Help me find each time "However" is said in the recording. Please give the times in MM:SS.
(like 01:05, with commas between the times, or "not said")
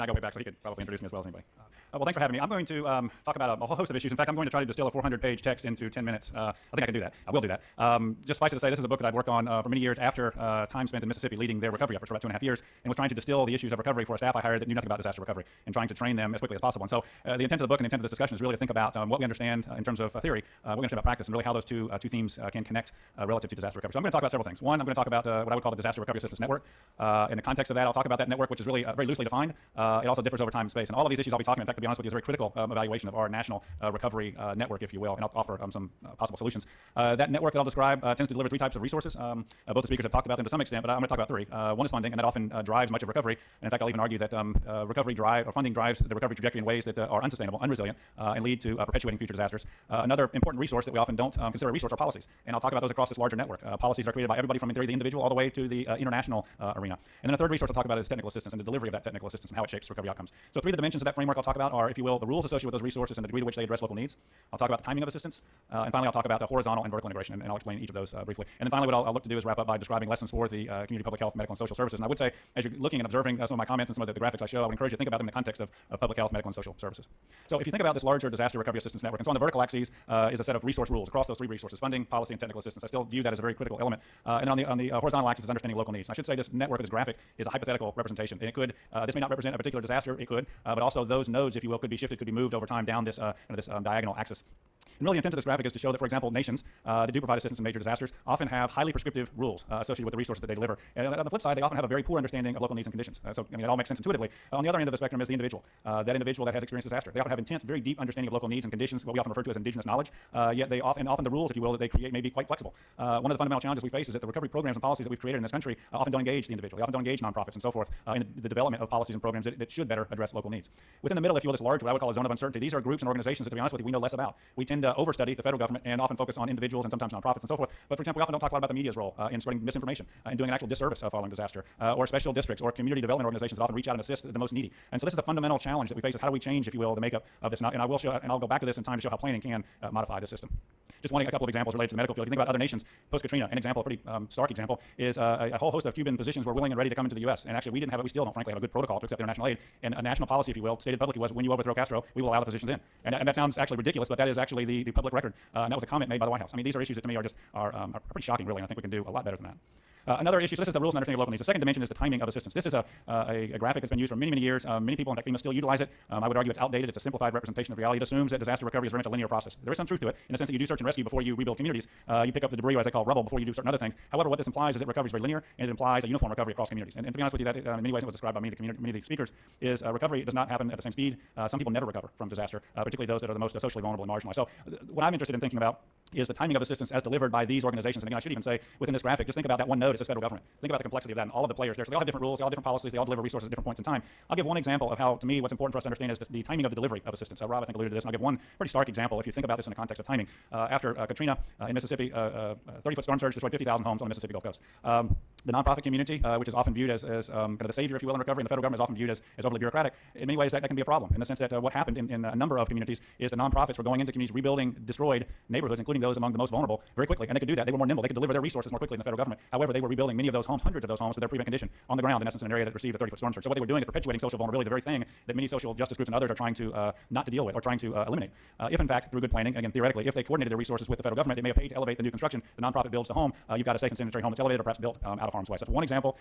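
02:54, 03:39.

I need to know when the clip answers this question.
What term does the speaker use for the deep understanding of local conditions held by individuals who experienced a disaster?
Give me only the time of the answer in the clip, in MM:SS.
01:49.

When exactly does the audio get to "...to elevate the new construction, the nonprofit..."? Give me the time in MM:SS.
03:51.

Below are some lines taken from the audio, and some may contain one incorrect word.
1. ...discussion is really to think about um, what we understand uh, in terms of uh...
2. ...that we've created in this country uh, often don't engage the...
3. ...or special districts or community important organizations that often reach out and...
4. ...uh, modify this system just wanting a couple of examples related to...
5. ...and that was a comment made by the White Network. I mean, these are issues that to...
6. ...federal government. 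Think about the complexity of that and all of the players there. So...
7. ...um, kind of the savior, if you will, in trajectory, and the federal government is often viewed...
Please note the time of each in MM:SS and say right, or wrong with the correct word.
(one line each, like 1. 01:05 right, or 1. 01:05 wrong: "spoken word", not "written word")
1. 00:18 right
2. 01:55 right
3. 02:11 wrong: "development", not "important"
4. 02:19 right
5. 02:35 wrong: "House", not "Network"
6. 03:10 right
7. 03:27 wrong: "recovery", not "trajectory".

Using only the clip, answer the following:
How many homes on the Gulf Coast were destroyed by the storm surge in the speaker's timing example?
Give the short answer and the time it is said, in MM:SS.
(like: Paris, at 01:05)
50,000, at 03:23.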